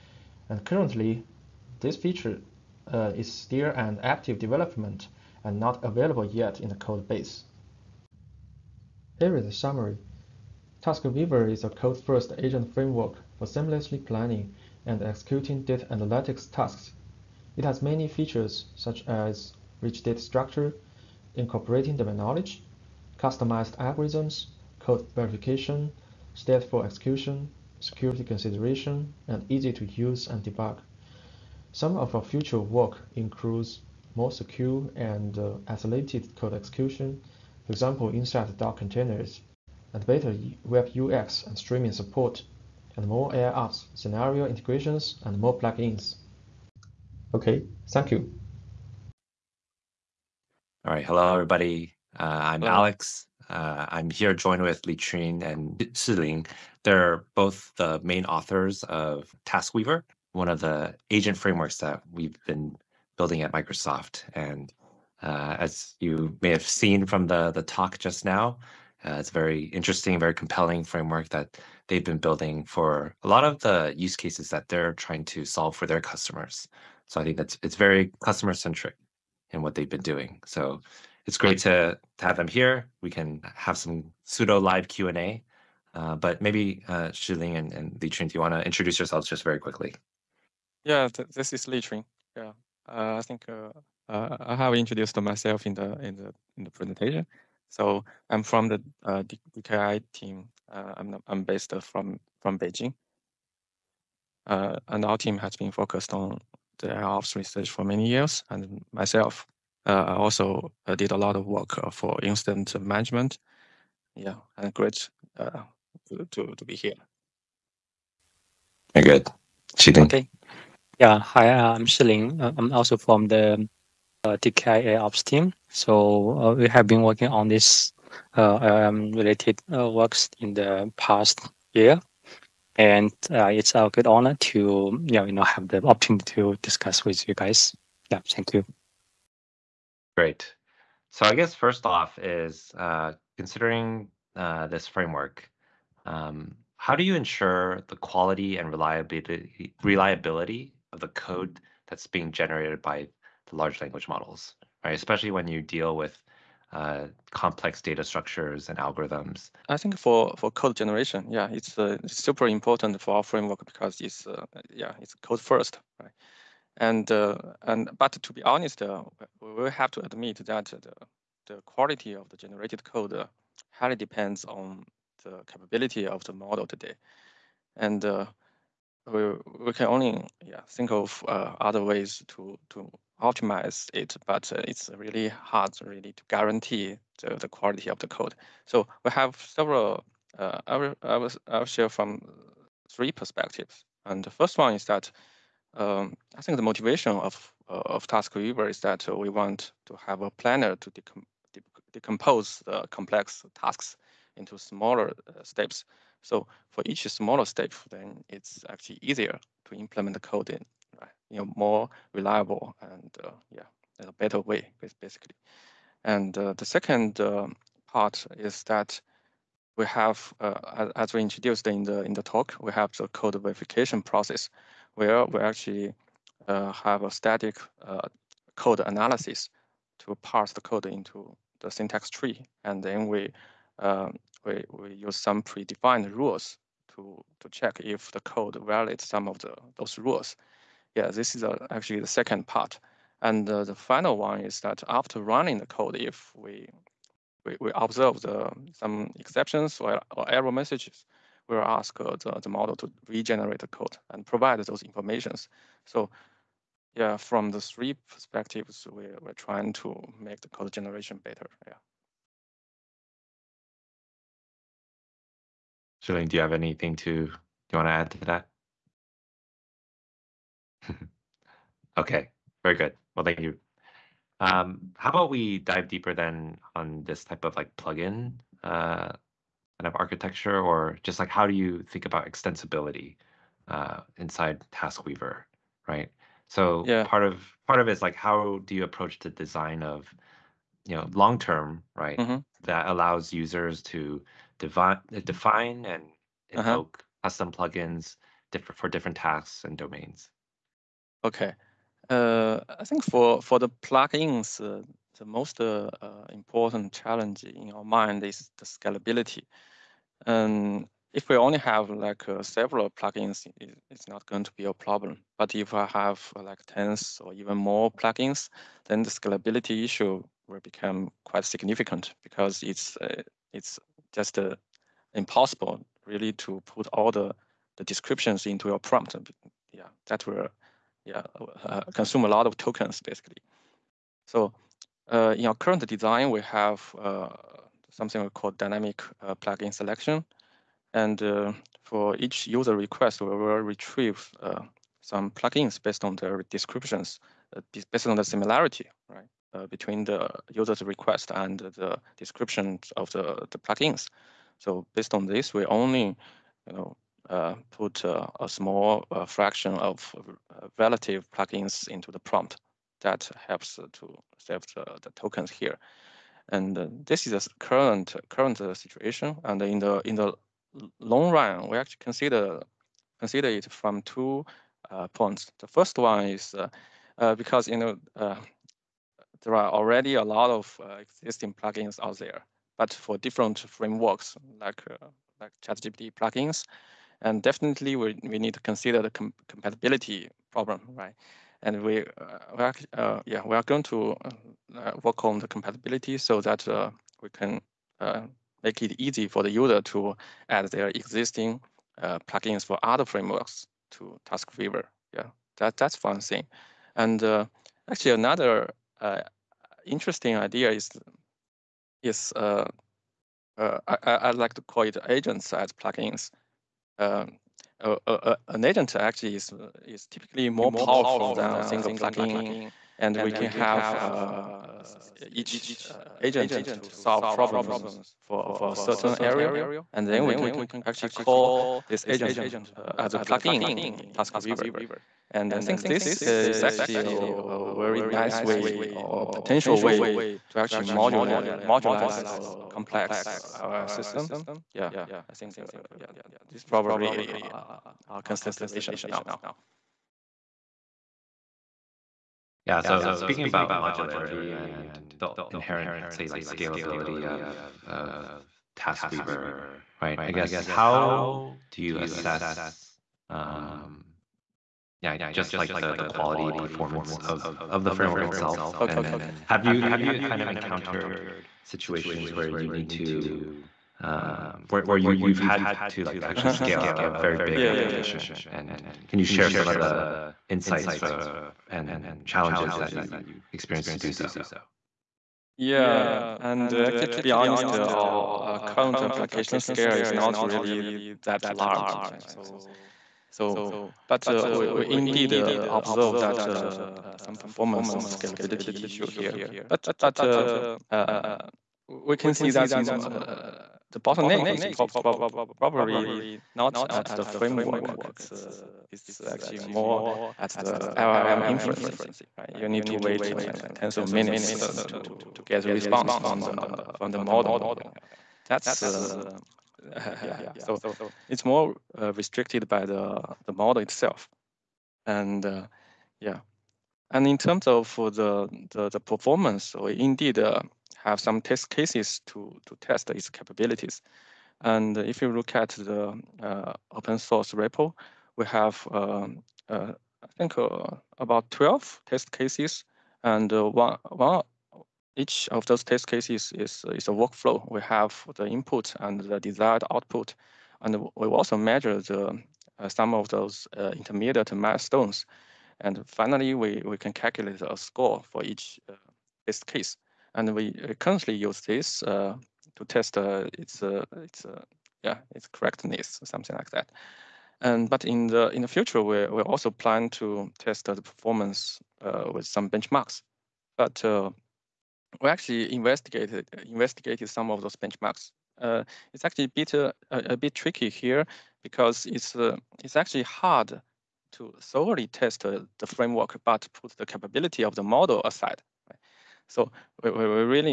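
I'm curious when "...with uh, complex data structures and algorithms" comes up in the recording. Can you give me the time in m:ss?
2:35.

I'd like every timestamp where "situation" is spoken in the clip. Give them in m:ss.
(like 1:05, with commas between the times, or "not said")
6:08, 7:51.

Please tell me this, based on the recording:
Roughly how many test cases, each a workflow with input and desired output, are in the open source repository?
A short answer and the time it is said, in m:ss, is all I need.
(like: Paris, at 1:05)
12, at 9:01.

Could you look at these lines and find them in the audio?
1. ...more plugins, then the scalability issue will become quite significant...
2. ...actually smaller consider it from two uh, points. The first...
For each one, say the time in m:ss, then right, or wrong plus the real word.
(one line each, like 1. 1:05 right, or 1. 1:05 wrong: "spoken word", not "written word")
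1. 5:17 right
2. 6:11 wrong: "consider", not "smaller".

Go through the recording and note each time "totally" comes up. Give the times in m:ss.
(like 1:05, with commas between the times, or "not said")
not said.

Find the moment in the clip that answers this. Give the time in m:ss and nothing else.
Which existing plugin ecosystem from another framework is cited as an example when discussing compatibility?
6:25.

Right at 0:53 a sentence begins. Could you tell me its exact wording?
Uh, I'm here joined with Liqun and Shilin.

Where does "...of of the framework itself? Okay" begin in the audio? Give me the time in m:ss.
7:47.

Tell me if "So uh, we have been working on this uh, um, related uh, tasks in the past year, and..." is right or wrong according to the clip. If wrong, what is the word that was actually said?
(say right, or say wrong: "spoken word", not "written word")
wrong: "works", not "tasks".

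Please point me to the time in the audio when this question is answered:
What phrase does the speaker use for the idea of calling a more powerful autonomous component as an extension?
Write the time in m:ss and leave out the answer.
6:55.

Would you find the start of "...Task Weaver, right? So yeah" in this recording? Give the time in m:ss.
4:44.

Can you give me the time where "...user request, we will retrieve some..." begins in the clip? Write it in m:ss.
5:42.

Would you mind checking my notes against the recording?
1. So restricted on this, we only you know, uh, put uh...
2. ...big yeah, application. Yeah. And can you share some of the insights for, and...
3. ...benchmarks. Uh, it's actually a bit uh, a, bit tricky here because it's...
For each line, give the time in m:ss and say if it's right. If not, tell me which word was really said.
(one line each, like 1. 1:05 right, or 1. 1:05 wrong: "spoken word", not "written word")
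1. 5:54 wrong: "based", not "restricted"
2. 7:57 right
3. 9:37 right.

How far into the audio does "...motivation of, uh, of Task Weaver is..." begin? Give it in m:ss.
3:16.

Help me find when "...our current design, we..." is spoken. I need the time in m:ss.
5:35.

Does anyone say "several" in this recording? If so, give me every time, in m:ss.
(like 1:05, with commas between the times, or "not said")
3:09, 5:12.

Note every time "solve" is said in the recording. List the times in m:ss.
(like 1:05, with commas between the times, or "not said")
1:15, 7:06.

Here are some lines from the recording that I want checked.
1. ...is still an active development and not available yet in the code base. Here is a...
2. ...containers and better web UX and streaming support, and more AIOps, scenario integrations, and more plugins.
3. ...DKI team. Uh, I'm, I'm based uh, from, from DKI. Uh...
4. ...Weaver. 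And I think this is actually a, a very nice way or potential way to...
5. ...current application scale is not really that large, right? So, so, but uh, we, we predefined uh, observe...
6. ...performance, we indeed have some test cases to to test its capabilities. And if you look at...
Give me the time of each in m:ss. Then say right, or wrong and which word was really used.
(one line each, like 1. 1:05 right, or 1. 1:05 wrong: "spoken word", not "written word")
1. 0:03 right
2. 0:38 right
3. 1:39 wrong: "Beijing", not "DKI"
4. 7:14 right
5. 8:08 wrong: "indeed", not "predefined"
6. 8:48 right.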